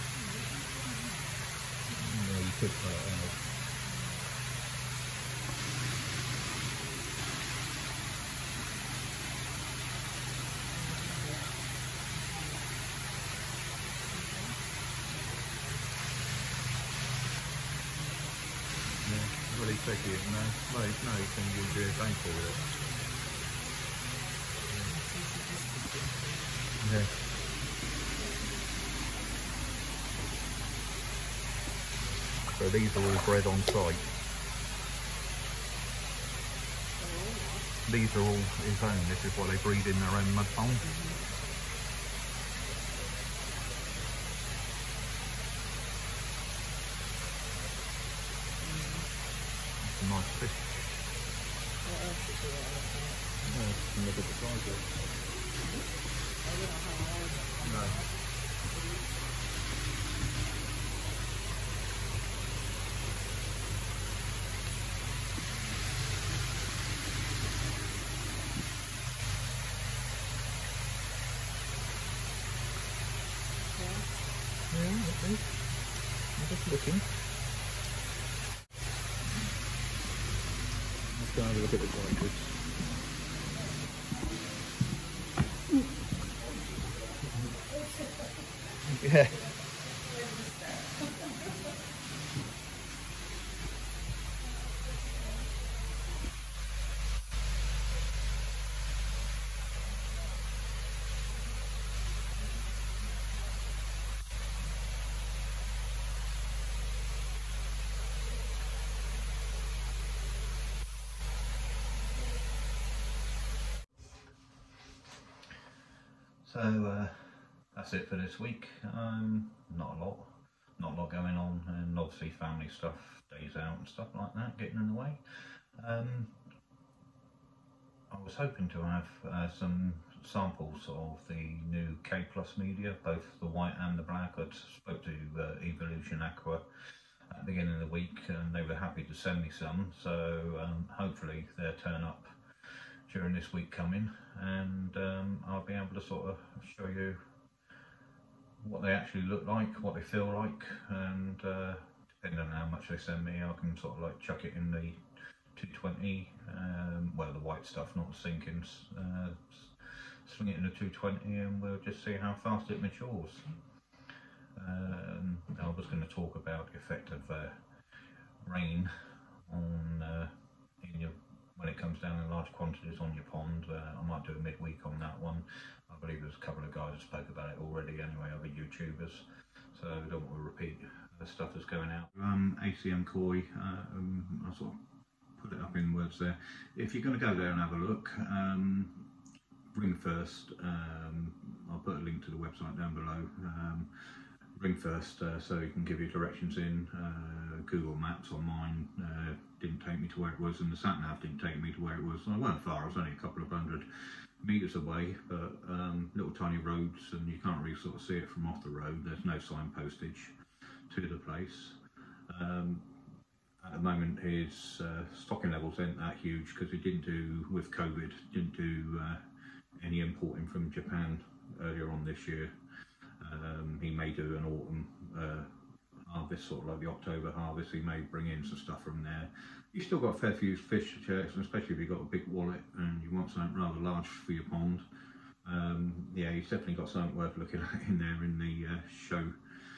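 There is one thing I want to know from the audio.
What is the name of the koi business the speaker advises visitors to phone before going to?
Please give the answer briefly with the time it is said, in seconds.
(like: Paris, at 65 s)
ACM Koi, at 182 s.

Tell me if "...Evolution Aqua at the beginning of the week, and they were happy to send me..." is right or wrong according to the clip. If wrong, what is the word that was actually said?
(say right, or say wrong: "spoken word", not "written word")
right.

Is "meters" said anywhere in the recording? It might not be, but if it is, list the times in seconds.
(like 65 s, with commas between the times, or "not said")
204 s.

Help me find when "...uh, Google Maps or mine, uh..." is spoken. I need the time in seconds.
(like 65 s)
196 s.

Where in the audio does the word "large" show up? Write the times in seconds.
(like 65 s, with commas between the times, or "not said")
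172 s, 233 s.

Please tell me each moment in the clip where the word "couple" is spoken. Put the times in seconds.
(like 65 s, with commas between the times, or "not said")
176 s, 203 s.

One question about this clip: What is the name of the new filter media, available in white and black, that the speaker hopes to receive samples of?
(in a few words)
K Plus.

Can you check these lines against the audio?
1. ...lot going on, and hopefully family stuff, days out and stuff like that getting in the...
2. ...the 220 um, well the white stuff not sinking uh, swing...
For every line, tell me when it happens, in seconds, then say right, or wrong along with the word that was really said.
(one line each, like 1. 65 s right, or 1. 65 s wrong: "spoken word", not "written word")
1. 121 s wrong: "obviously", not "hopefully"
2. 154 s right.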